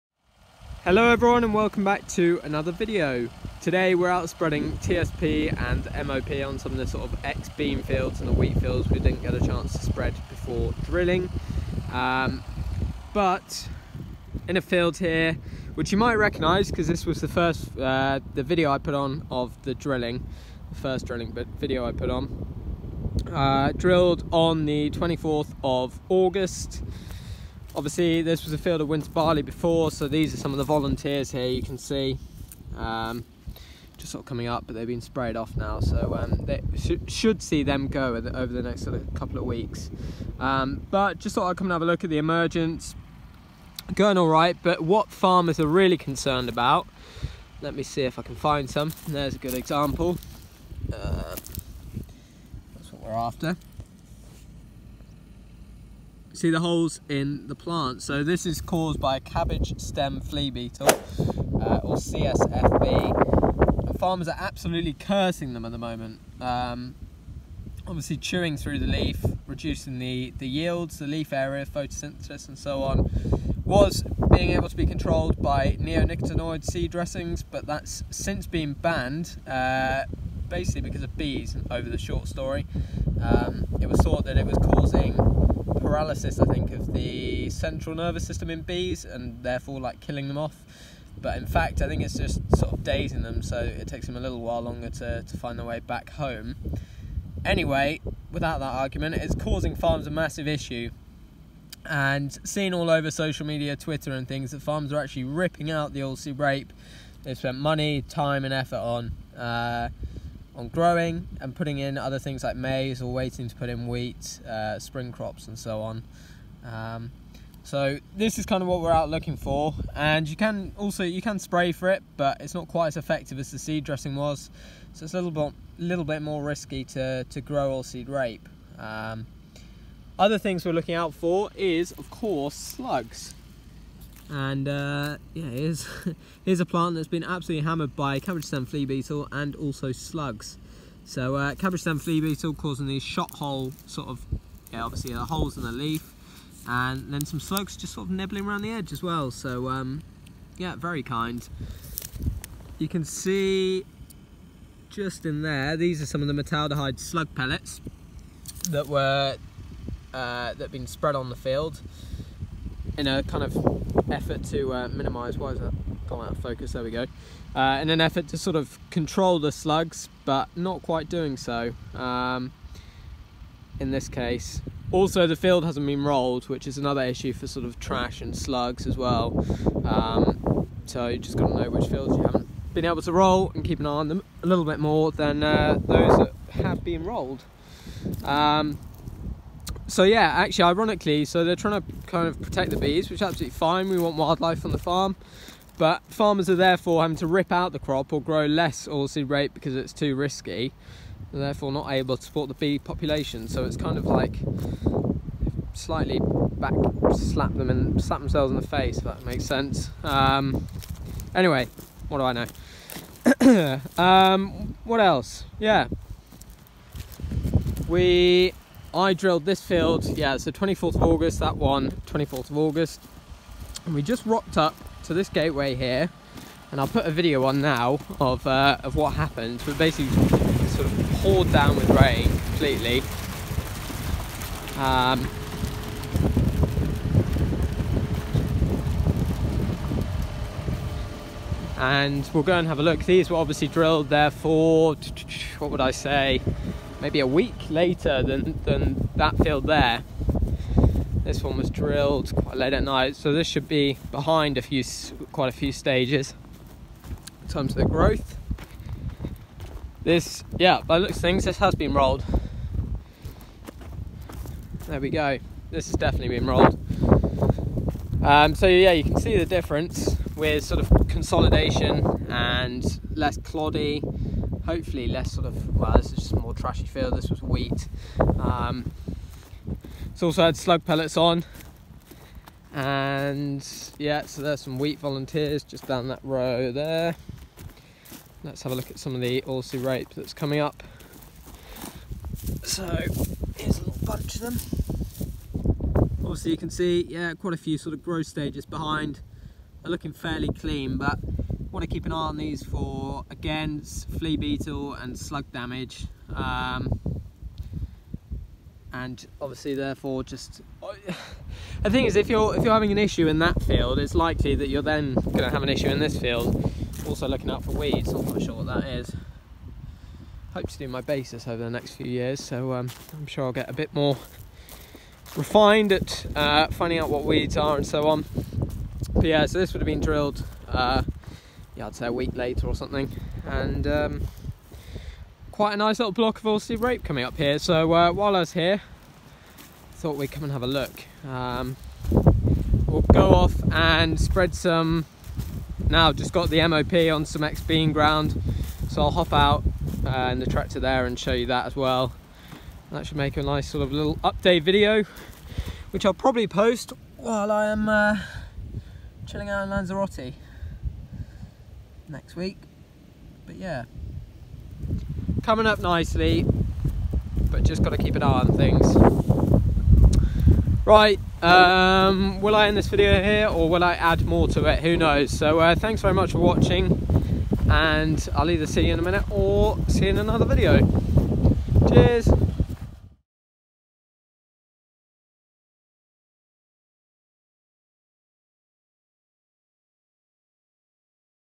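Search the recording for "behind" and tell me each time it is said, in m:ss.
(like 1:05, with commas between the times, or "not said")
4:14, 4:58.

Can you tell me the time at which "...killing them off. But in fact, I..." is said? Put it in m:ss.
1:29.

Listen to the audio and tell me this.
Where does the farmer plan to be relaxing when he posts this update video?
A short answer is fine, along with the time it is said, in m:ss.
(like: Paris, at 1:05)
Lanzarote, at 5:59.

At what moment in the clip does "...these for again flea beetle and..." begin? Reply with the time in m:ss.
5:02.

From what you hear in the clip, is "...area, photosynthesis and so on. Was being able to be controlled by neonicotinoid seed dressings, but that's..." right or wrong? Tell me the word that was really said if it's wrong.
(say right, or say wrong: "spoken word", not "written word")
right.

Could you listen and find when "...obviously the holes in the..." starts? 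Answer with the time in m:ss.
2:24.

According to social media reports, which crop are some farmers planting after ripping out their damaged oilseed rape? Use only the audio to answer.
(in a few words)
Maize.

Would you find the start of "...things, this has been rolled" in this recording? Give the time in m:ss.
4:21.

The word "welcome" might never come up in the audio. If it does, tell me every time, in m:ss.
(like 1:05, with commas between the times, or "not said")
0:01.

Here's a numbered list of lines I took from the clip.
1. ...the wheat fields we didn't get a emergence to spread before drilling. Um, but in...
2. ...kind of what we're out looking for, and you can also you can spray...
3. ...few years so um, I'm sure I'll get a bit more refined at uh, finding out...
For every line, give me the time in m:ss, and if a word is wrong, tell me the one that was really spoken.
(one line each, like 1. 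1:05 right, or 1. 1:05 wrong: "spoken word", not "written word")
1. 0:08 wrong: "chance", not "emergence"
2. 1:58 right
3. 5:21 right.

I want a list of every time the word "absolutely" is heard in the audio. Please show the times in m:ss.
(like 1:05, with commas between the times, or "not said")
1:04, 2:17, 3:13.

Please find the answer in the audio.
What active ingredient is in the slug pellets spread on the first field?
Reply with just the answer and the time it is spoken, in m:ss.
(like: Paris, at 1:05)
Metaldehyde, at 2:36.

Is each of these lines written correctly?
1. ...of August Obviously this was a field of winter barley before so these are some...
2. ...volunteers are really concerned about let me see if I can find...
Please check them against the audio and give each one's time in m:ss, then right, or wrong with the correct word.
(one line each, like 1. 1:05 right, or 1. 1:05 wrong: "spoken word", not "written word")
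1. 0:25 right
2. 0:45 wrong: "farmers", not "volunteers".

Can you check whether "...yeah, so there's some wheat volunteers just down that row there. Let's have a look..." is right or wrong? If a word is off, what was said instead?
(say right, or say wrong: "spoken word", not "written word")
right.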